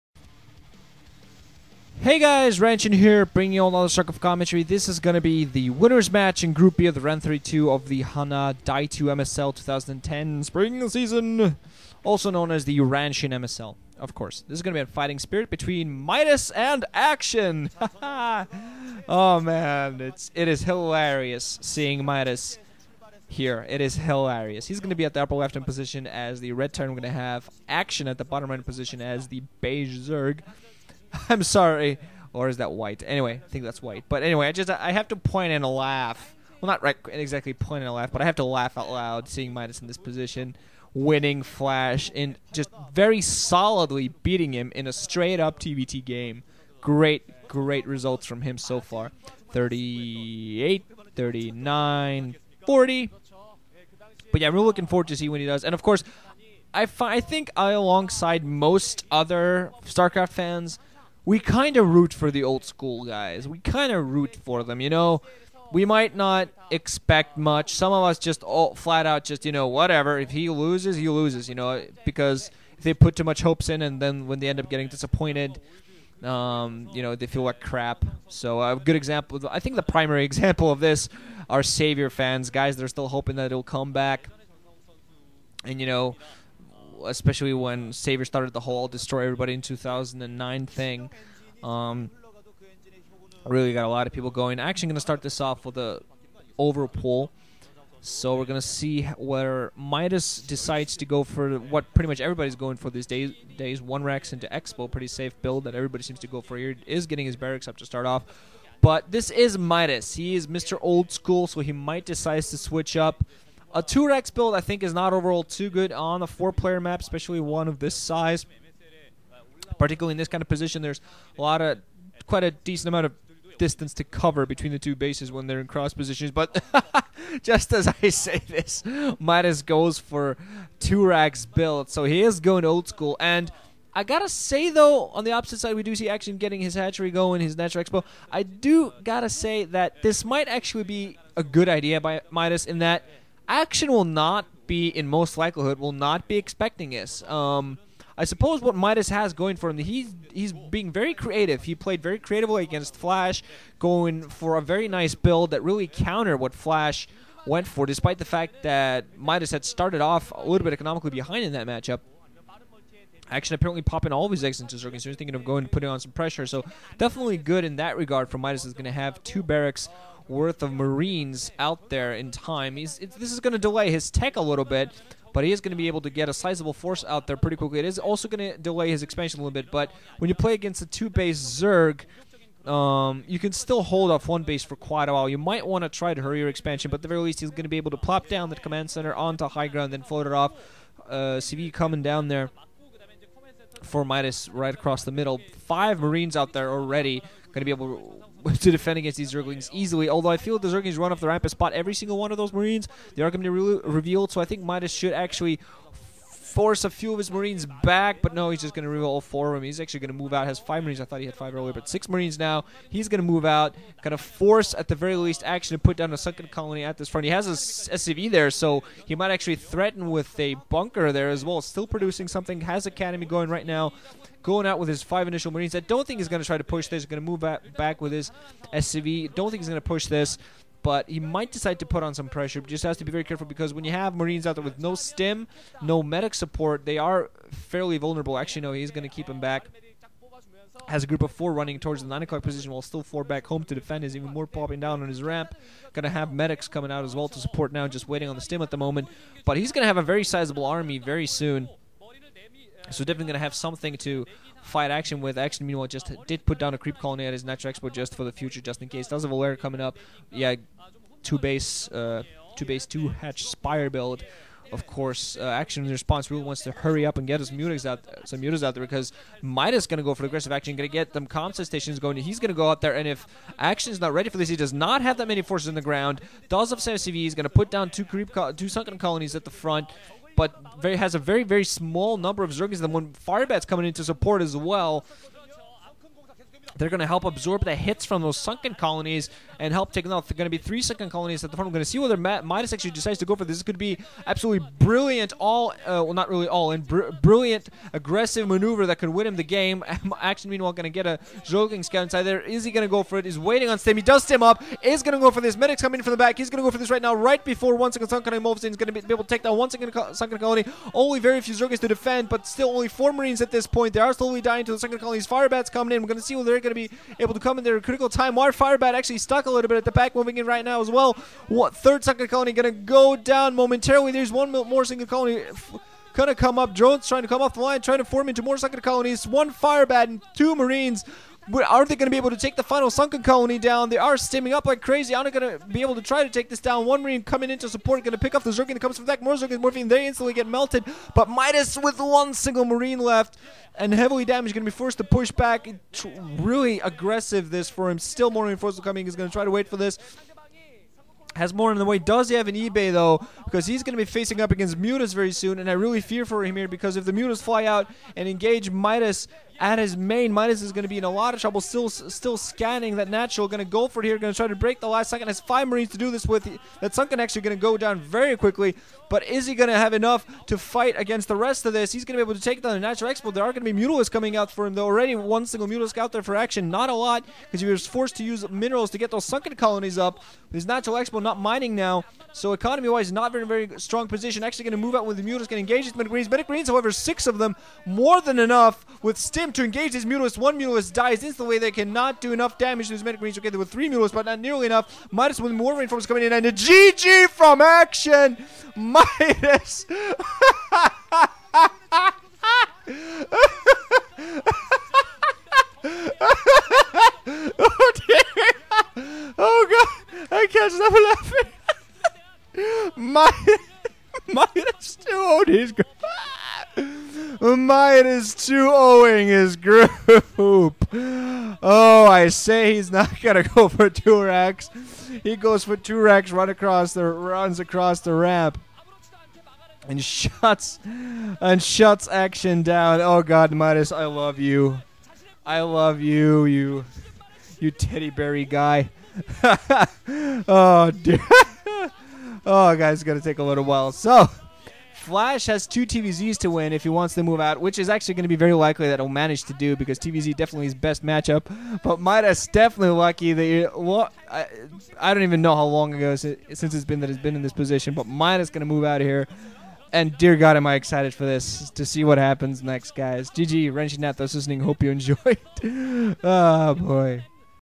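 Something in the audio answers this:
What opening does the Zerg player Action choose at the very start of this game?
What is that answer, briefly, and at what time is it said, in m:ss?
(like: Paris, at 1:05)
Overpool, at 1:36.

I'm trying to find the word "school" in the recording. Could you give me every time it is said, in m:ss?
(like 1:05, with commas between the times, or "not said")
1:02, 1:51, 2:12.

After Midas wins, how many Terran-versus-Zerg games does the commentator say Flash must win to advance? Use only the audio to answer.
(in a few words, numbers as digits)
2.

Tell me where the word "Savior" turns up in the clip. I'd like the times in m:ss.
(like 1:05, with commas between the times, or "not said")
1:21, 1:27.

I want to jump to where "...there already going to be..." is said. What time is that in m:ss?
3:16.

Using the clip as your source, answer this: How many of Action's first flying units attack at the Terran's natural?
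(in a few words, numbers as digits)
6.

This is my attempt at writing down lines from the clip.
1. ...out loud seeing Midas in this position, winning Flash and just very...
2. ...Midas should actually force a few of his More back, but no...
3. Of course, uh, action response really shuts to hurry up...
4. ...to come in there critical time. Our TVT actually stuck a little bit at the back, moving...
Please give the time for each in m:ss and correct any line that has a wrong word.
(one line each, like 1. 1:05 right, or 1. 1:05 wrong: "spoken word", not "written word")
1. 0:38 right
2. 3:24 wrong: "Marines", not "More"
3. 4:24 wrong: "wants", not "shuts"
4. 5:17 wrong: "Firebat", not "TVT".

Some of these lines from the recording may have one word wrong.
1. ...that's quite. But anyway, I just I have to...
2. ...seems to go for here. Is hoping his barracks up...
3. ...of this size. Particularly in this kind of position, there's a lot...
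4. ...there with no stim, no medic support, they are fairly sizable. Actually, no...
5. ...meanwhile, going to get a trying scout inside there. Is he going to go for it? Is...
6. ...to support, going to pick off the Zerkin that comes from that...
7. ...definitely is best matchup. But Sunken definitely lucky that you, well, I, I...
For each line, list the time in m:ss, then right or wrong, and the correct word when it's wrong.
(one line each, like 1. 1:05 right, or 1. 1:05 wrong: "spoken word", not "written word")
1. 0:33 wrong: "white", not "quite"
2. 1:46 wrong: "getting", not "hoping"
3. 1:57 right
4. 3:54 wrong: "vulnerable", not "sizable"
5. 5:00 wrong: "joking", not "trying"
6. 5:37 right
7. 7:30 wrong: "Midas", not "Sunken".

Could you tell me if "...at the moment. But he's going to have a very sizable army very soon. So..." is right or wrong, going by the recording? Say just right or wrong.
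right.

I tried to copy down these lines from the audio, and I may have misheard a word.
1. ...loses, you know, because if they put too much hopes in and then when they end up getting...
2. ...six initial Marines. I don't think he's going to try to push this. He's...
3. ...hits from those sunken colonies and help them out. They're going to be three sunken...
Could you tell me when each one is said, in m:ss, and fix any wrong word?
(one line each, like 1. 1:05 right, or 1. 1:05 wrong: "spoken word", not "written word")
1. 1:11 right
2. 3:45 wrong: "five", not "six"
3. 4:47 right.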